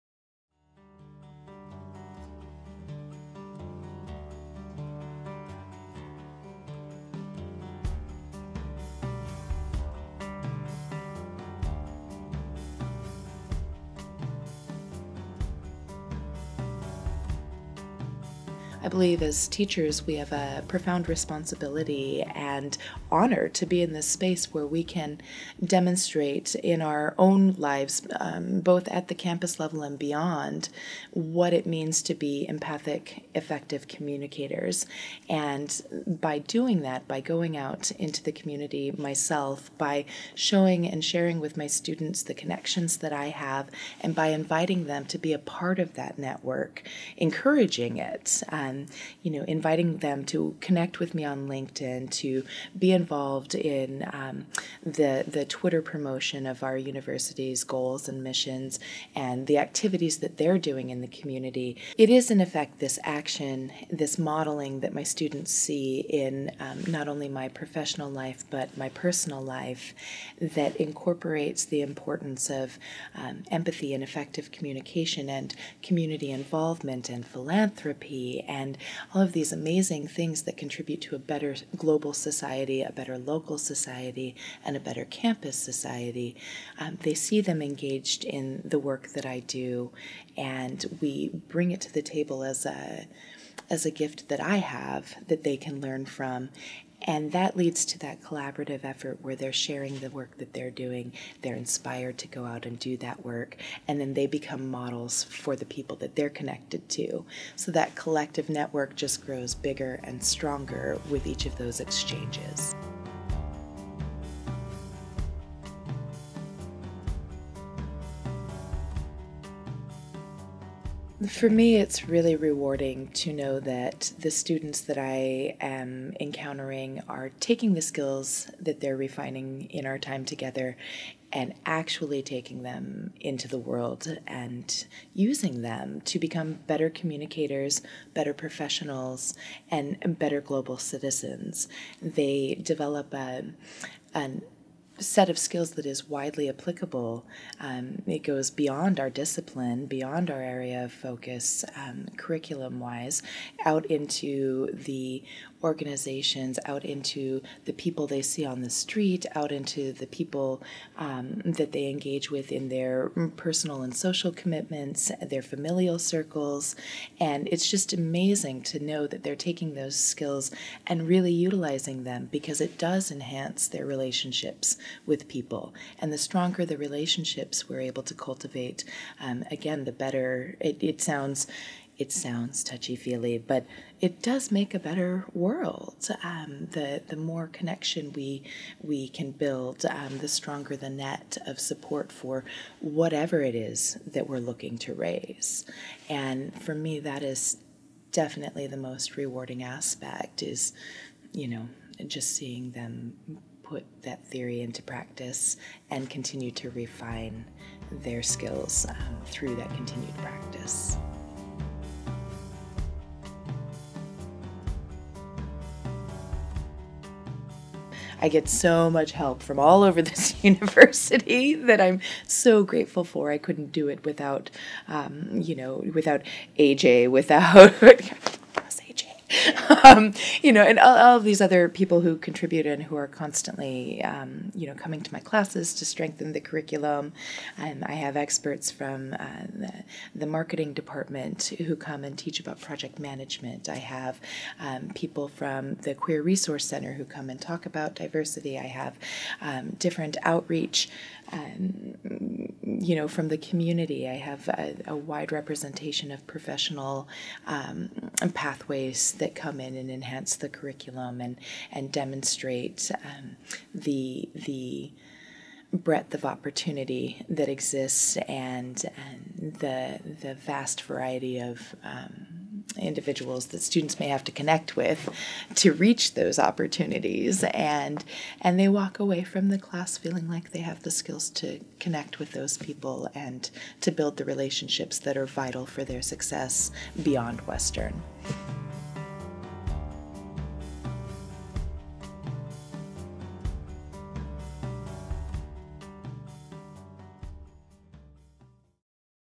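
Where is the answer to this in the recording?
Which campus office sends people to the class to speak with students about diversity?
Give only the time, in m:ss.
4:05.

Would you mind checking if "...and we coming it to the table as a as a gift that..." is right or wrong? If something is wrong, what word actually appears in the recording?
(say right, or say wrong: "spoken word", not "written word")
wrong: "bring", not "coming".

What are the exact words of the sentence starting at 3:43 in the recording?
I couldn't do it without, um, you know, without AJ, without.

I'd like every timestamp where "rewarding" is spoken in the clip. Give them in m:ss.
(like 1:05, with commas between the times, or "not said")
2:02, 3:19.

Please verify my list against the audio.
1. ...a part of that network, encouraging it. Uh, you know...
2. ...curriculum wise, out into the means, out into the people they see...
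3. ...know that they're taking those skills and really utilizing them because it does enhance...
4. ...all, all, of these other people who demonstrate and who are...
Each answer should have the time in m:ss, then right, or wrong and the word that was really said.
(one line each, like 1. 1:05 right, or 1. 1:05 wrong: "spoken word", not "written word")
1. 0:45 right
2. 2:32 wrong: "organizations", not "means"
3. 2:48 right
4. 3:50 wrong: "contribute", not "demonstrate".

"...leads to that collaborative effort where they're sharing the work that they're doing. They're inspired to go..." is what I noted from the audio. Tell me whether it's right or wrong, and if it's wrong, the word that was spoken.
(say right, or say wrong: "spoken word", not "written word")
right.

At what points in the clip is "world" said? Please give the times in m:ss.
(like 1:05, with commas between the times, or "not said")
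2:13, 3:05.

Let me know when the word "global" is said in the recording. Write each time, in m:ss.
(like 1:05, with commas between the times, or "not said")
1:21, 2:20.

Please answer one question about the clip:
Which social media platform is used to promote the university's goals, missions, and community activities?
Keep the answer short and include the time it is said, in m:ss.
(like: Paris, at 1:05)
Twitter, at 0:55.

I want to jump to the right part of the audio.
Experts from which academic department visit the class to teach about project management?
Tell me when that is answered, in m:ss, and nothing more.
4:00.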